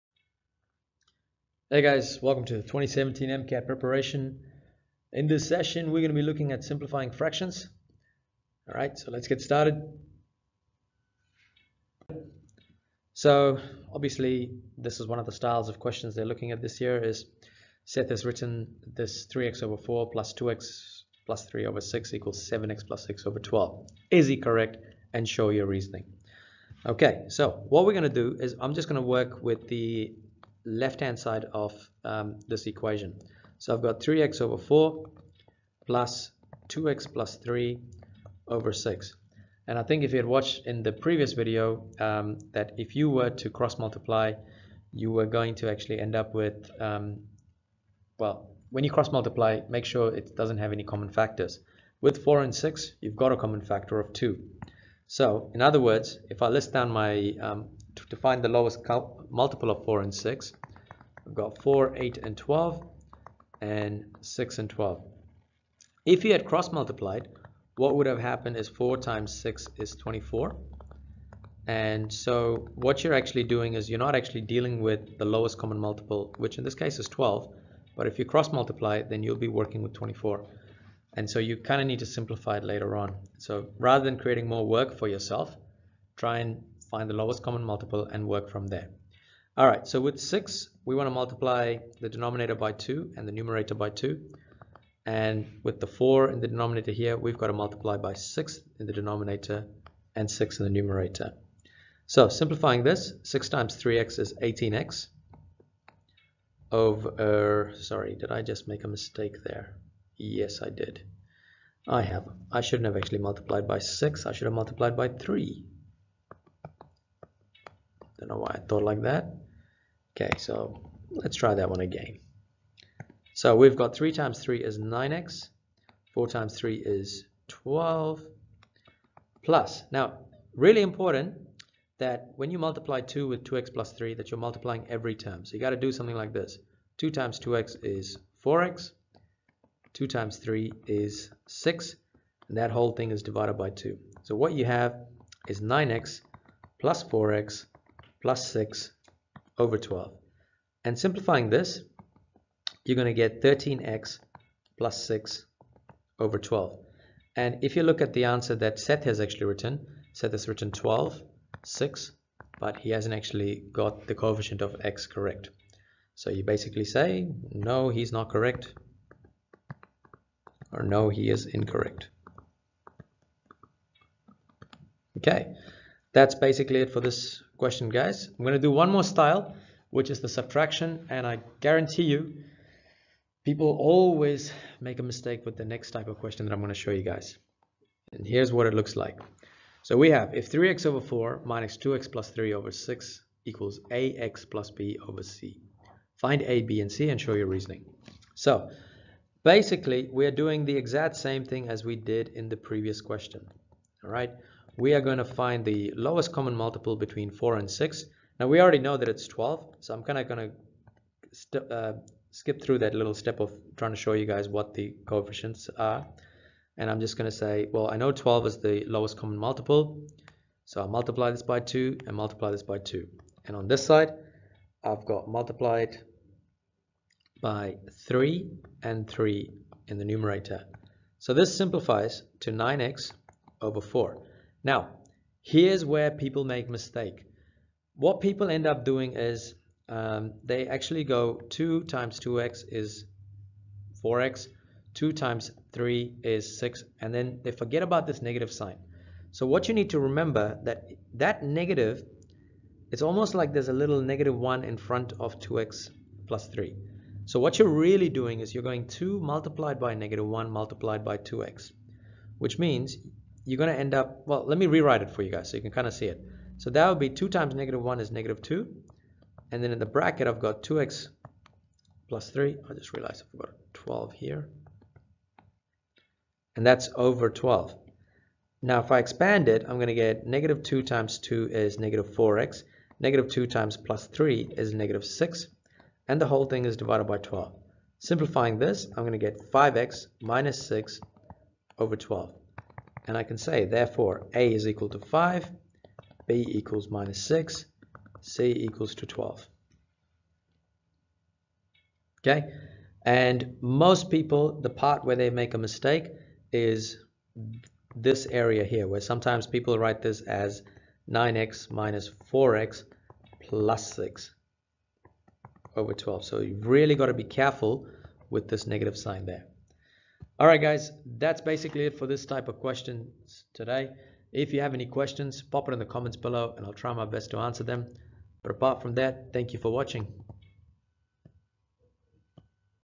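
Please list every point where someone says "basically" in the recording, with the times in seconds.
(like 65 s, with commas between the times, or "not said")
166 s, 176 s, 199 s, 321 s.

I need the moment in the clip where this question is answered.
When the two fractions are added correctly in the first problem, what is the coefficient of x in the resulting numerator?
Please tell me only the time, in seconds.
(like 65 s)
153 s.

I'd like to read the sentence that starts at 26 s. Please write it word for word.
Okay, so what we're going to do is I'm just going to work with the left-hand side of um, this equation.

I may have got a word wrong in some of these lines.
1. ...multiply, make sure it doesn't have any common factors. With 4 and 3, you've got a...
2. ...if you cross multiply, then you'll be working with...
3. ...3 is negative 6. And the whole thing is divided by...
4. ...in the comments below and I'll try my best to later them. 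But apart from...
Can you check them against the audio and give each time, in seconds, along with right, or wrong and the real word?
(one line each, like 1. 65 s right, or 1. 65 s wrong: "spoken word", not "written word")
1. 49 s wrong: "6", not "3"
2. 78 s right
3. 284 s right
4. 325 s wrong: "answer", not "later".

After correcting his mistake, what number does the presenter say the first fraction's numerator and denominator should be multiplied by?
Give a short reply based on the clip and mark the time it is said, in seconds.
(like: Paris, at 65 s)
3, at 114 s.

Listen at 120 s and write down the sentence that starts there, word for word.
Okay, so let's try that one again.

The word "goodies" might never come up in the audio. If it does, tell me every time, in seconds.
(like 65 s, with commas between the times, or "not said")
not said.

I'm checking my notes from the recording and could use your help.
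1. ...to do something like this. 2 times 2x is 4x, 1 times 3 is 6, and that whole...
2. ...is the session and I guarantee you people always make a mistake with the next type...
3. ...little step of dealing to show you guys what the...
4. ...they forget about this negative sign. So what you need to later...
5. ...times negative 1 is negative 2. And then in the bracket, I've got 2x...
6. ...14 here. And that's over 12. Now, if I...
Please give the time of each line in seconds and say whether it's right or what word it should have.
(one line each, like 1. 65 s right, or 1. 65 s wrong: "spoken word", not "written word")
1. 135 s wrong: "2", not "1"
2. 180 s wrong: "subtraction", not "session"
3. 212 s wrong: "trying", not "dealing"
4. 247 s wrong: "remember", not "later"
5. 267 s right
6. 273 s wrong: "12", not "14".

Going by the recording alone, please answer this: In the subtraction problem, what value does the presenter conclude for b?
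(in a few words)
-6.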